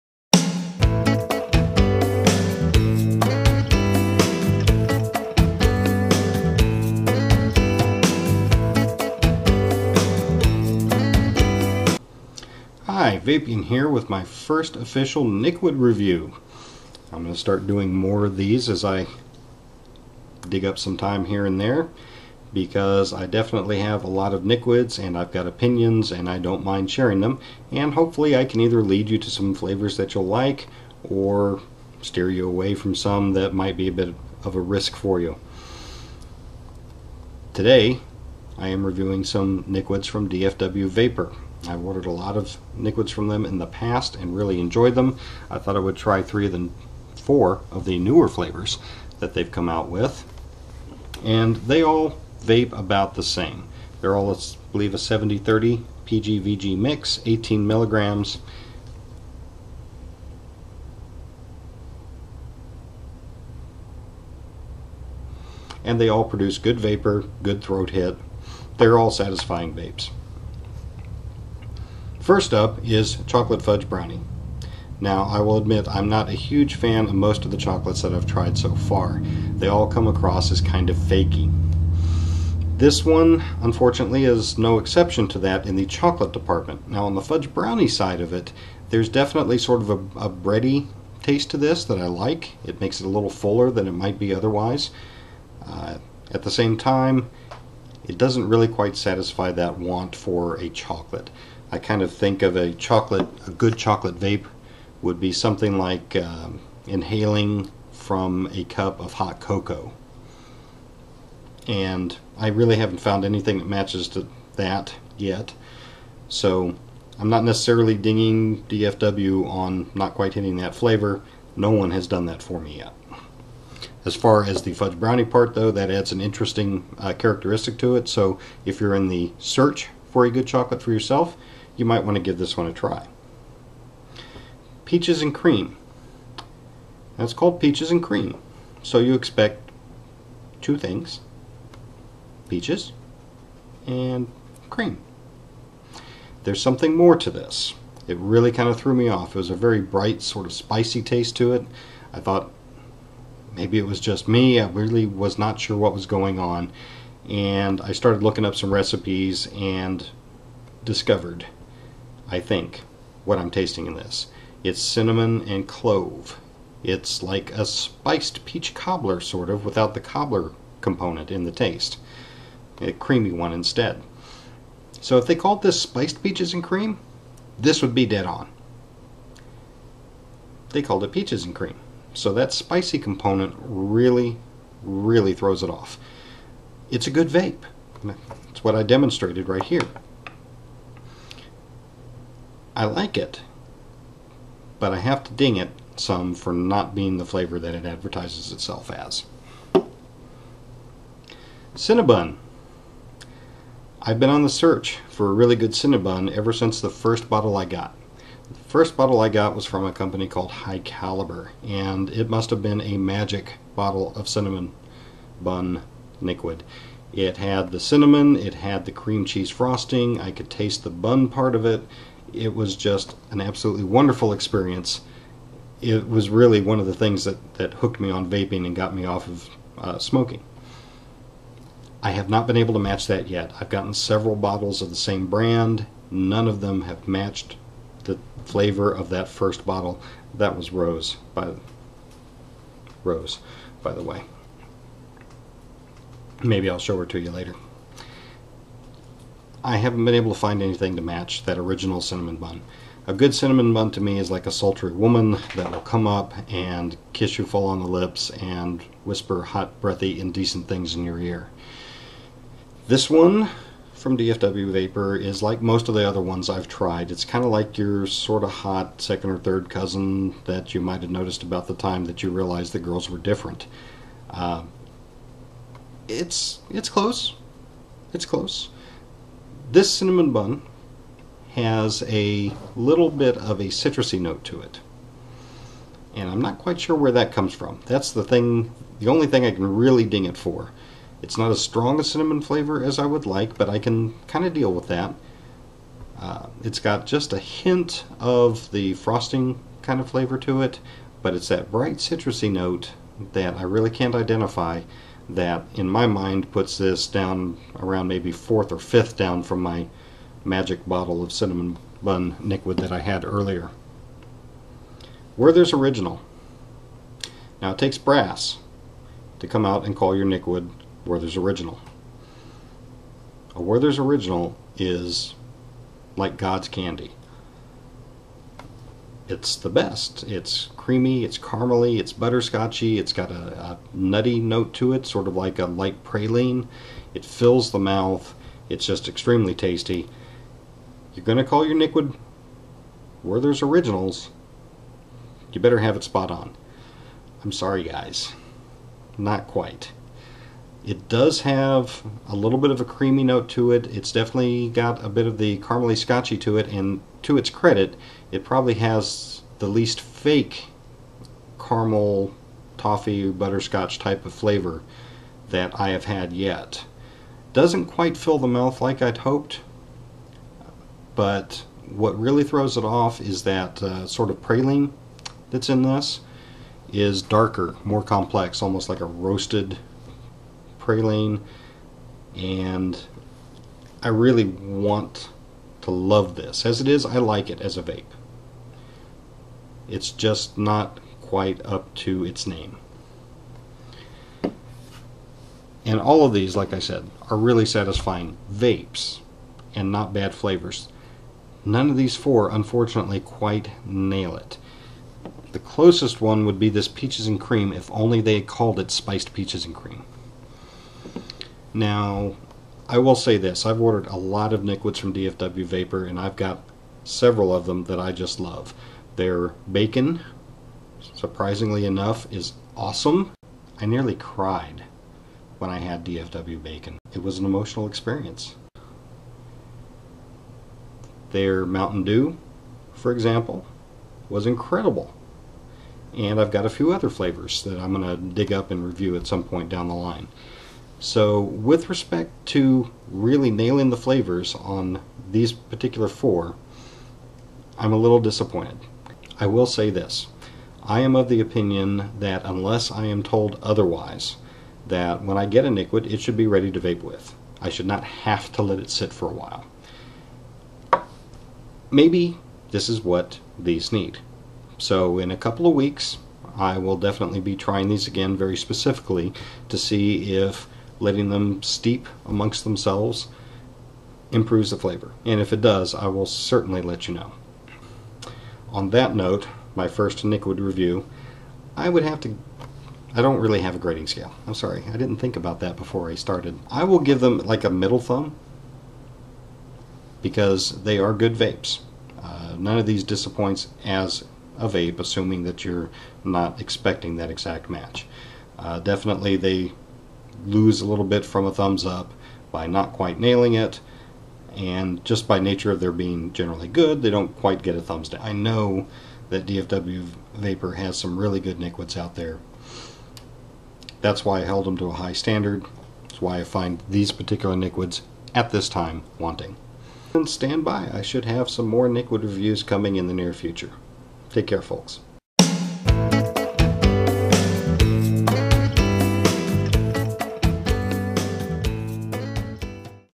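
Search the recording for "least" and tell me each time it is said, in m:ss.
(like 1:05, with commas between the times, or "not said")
5:59.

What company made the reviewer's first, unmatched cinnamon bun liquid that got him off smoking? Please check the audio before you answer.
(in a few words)
High Caliber.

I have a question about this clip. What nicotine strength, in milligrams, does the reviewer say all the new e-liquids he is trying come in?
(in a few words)
18.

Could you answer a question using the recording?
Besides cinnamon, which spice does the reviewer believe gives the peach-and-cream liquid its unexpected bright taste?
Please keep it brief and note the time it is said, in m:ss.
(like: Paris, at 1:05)
Clove, at 2:45.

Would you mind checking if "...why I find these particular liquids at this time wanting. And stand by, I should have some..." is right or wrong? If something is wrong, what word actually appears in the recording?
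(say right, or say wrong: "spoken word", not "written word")
right.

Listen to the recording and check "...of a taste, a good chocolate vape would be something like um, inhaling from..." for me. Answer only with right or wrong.
wrong.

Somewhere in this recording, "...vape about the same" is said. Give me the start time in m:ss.
0:52.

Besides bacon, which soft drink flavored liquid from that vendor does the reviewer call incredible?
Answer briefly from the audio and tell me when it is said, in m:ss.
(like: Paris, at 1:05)
Mountain Dew, at 7:11.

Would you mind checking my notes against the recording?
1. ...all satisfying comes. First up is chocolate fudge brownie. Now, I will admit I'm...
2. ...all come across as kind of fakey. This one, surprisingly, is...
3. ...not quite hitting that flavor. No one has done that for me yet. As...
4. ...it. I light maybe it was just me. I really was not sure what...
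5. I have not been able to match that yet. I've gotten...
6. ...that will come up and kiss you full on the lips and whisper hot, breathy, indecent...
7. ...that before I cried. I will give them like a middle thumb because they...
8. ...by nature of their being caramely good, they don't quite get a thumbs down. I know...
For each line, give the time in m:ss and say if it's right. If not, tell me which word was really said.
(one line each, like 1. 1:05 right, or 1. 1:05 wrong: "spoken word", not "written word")
1. 1:08 wrong: "vapes", not "comes"
2. 1:19 wrong: "unfortunately", not "surprisingly"
3. 1:59 right
4. 2:31 wrong: "thought", not "light"
5. 3:52 right
6. 4:15 right
7. 8:05 wrong: "started", not "cried"
8. 8:25 wrong: "generally", not "caramely".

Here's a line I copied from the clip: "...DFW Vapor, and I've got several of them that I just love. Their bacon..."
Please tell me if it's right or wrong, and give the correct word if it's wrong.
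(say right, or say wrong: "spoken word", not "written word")
right.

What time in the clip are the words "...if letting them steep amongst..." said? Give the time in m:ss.
7:50.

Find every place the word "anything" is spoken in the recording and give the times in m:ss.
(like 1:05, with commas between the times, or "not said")
1:53, 4:10.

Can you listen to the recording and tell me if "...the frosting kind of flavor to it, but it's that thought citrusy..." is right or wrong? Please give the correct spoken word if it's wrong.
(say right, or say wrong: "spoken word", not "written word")
wrong: "bright", not "thought".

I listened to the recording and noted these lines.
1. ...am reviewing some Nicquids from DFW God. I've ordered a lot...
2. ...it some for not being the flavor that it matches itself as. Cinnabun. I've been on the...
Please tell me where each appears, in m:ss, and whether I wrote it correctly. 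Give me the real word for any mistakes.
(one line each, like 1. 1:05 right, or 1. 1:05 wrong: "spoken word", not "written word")
1. 0:38 wrong: "Vapor", not "God"
2. 3:15 wrong: "advertises", not "matches".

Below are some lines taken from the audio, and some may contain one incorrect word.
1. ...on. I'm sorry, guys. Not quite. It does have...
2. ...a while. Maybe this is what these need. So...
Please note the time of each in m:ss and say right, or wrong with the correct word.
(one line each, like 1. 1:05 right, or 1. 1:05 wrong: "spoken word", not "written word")
1. 5:46 right
2. 7:39 right.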